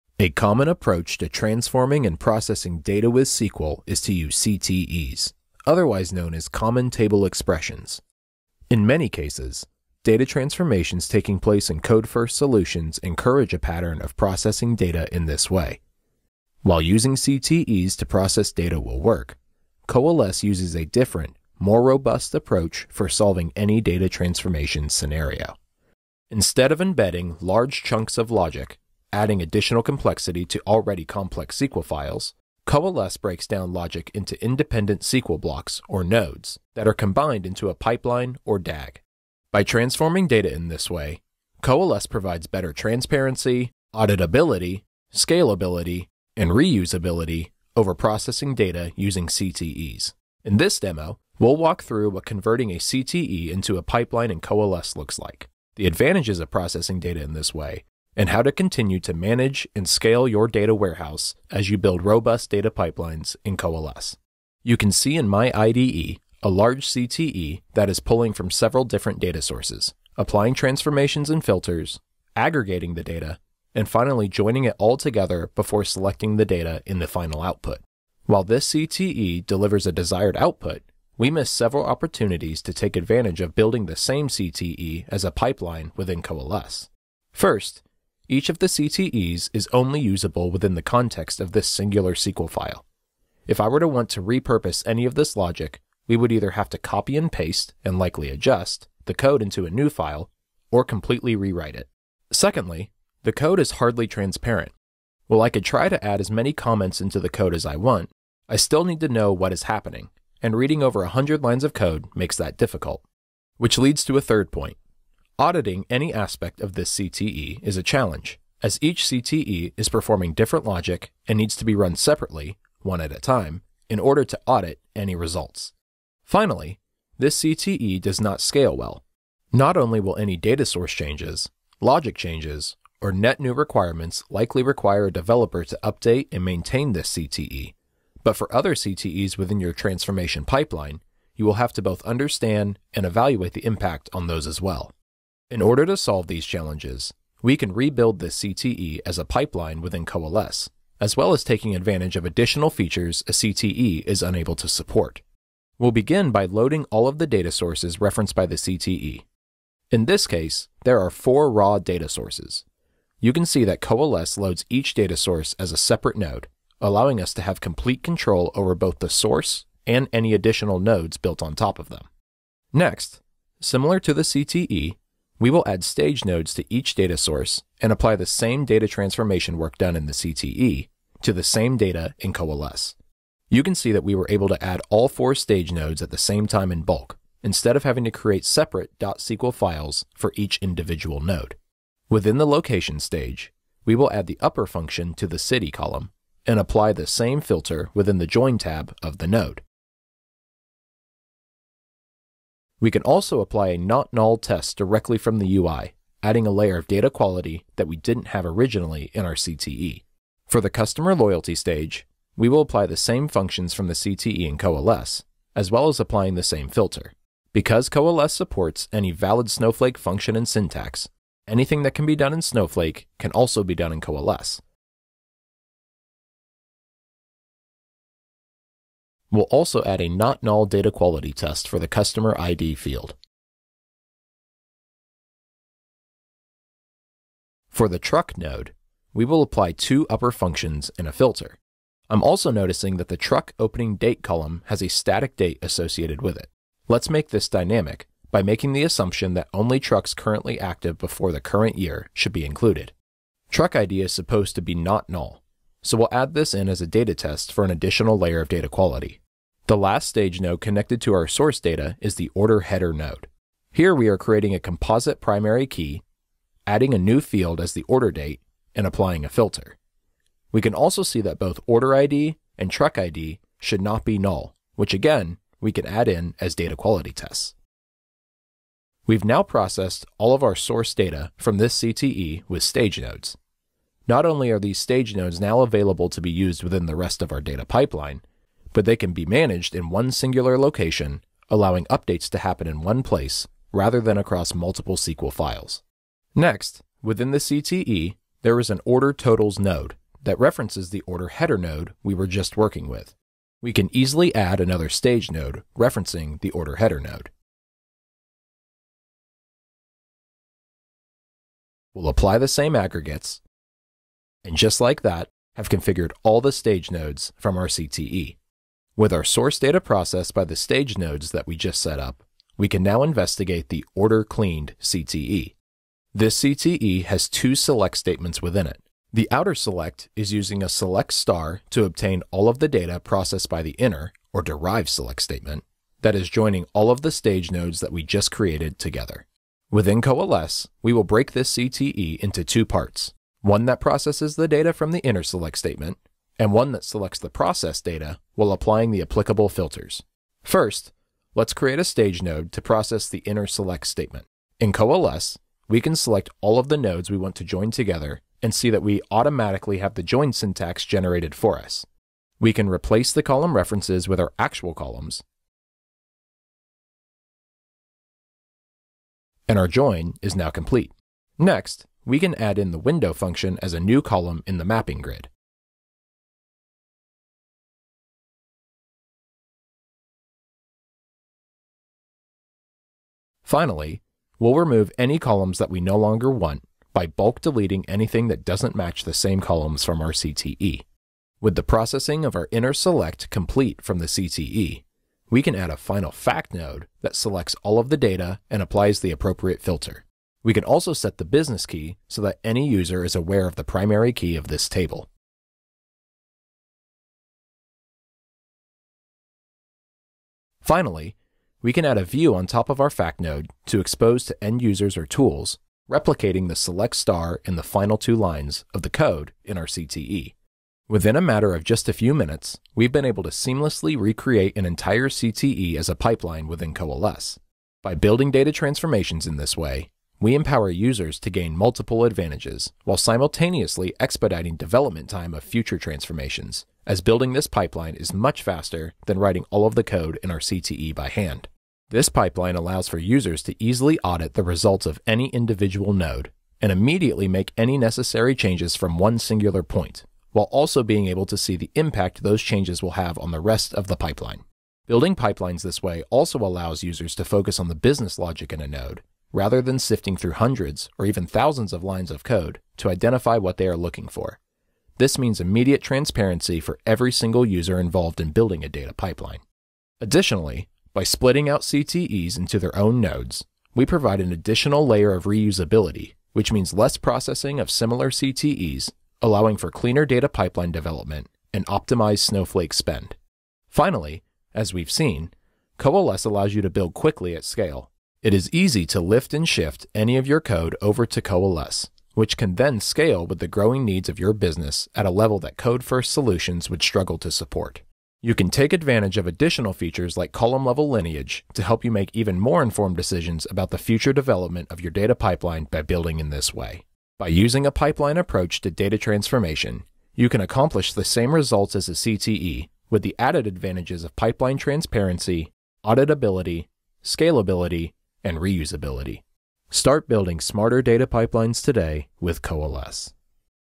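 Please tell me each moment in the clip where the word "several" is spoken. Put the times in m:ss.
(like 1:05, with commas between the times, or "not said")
1:08, 1:21.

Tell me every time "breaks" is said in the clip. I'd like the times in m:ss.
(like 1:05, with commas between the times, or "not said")
0:33, 5:41.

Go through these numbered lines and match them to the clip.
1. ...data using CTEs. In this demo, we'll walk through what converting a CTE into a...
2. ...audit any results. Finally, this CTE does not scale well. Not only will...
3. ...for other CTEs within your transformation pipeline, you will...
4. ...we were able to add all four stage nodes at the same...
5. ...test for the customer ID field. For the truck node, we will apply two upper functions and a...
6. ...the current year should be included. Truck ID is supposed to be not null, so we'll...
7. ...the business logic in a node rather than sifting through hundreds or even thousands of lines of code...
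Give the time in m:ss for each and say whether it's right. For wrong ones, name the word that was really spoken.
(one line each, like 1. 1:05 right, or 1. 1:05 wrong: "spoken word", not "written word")
1. 0:48 right
2. 2:04 right
3. 2:18 right
4. 3:04 right
5. 3:51 right
6. 4:11 right
7. 7:37 right.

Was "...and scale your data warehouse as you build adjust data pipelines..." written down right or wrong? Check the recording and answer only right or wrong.
wrong.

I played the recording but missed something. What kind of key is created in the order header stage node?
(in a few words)
composite primary key.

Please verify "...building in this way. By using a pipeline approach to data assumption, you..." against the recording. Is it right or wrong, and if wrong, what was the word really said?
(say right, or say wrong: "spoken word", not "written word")
wrong: "transformation", not "assumption".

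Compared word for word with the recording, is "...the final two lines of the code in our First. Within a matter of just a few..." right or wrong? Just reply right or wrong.
wrong.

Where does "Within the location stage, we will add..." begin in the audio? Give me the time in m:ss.
3:12.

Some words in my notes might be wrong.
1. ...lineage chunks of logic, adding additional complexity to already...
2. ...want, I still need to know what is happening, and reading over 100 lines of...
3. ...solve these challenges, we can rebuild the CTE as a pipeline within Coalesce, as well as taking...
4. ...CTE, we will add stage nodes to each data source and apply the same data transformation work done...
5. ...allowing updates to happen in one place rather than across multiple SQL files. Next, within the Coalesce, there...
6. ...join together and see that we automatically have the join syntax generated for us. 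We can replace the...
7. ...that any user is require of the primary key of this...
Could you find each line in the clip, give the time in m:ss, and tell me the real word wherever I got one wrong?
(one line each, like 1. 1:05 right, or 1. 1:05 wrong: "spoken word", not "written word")
1. 0:27 wrong: "large", not "lineage"
2. 1:47 right
3. 2:25 right
4. 2:54 right
5. 4:51 wrong: "CTE", not "Coalesce"
6. 5:57 right
7. 6:42 wrong: "aware", not "require".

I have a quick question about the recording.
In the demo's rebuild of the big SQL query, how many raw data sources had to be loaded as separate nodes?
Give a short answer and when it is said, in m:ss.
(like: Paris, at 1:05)
4, at 2:41.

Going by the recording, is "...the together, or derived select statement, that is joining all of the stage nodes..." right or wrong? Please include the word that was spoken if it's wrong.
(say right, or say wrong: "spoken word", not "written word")
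wrong: "inner", not "together".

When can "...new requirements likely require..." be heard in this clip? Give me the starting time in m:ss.
2:13.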